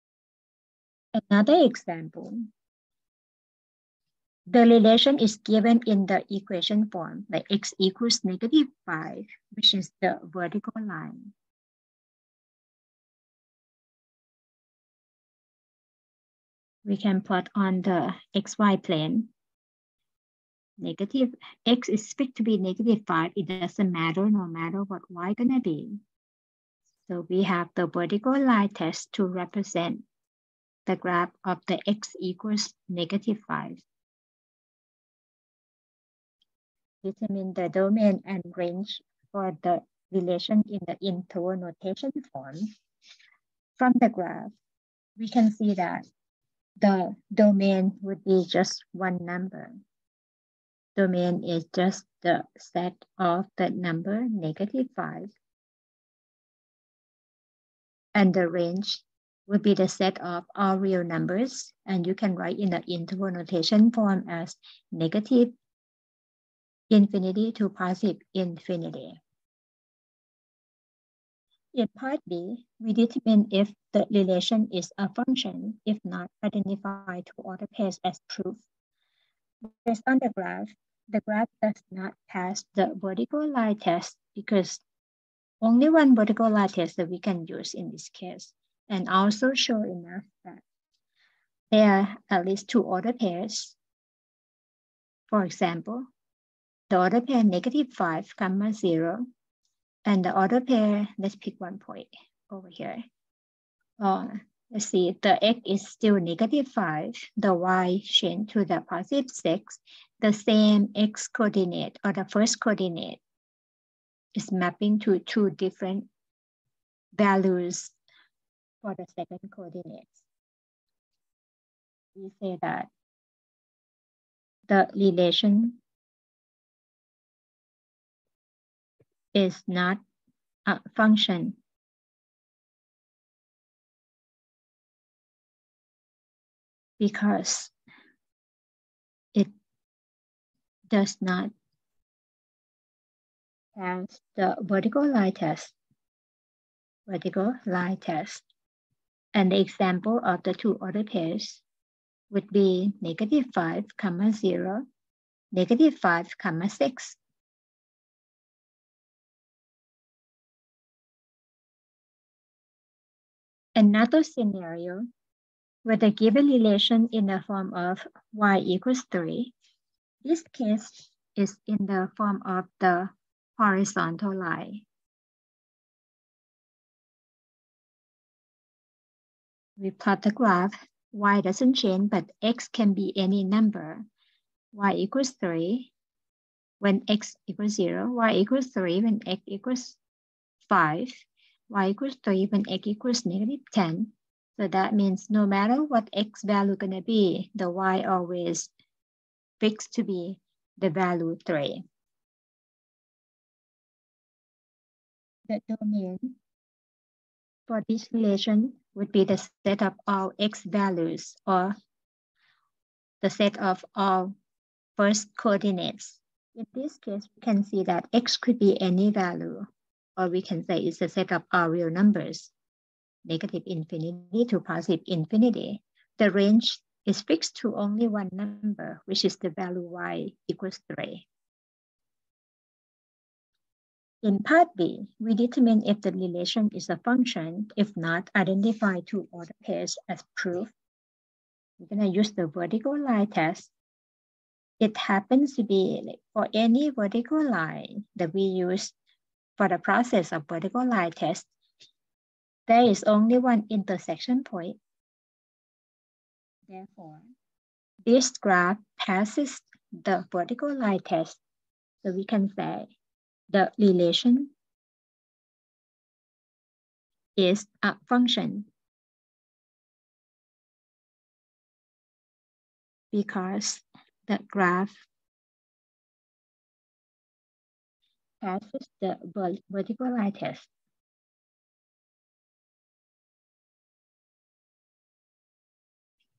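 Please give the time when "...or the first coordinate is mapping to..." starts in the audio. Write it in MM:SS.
01:52.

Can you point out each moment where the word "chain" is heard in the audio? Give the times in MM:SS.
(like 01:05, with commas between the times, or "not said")
01:48.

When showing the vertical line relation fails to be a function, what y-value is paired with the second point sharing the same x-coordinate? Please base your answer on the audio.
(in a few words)
6.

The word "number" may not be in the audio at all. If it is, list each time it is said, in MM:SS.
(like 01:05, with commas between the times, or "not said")
00:49, 00:53, 01:01, 03:03, 03:41, 03:48.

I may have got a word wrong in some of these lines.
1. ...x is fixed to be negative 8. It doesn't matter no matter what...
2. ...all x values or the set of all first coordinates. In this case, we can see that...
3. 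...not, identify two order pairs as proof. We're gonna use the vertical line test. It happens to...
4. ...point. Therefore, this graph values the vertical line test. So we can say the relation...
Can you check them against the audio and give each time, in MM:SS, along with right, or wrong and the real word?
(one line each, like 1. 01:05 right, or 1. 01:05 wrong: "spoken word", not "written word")
1. 00:21 wrong: "5", not "8"
2. 03:30 right
3. 03:57 right
4. 04:14 wrong: "passes", not "values".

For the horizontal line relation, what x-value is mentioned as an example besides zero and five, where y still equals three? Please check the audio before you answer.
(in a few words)
-10.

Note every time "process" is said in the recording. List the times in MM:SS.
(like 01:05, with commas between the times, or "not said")
04:09.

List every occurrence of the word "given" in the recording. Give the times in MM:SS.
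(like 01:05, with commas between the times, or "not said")
00:05, 02:46.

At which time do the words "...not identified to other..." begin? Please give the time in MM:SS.
01:16.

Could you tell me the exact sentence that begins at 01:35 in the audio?
For example, the order pair negative 5, comma 0, and the order pair, let's pick one point over here.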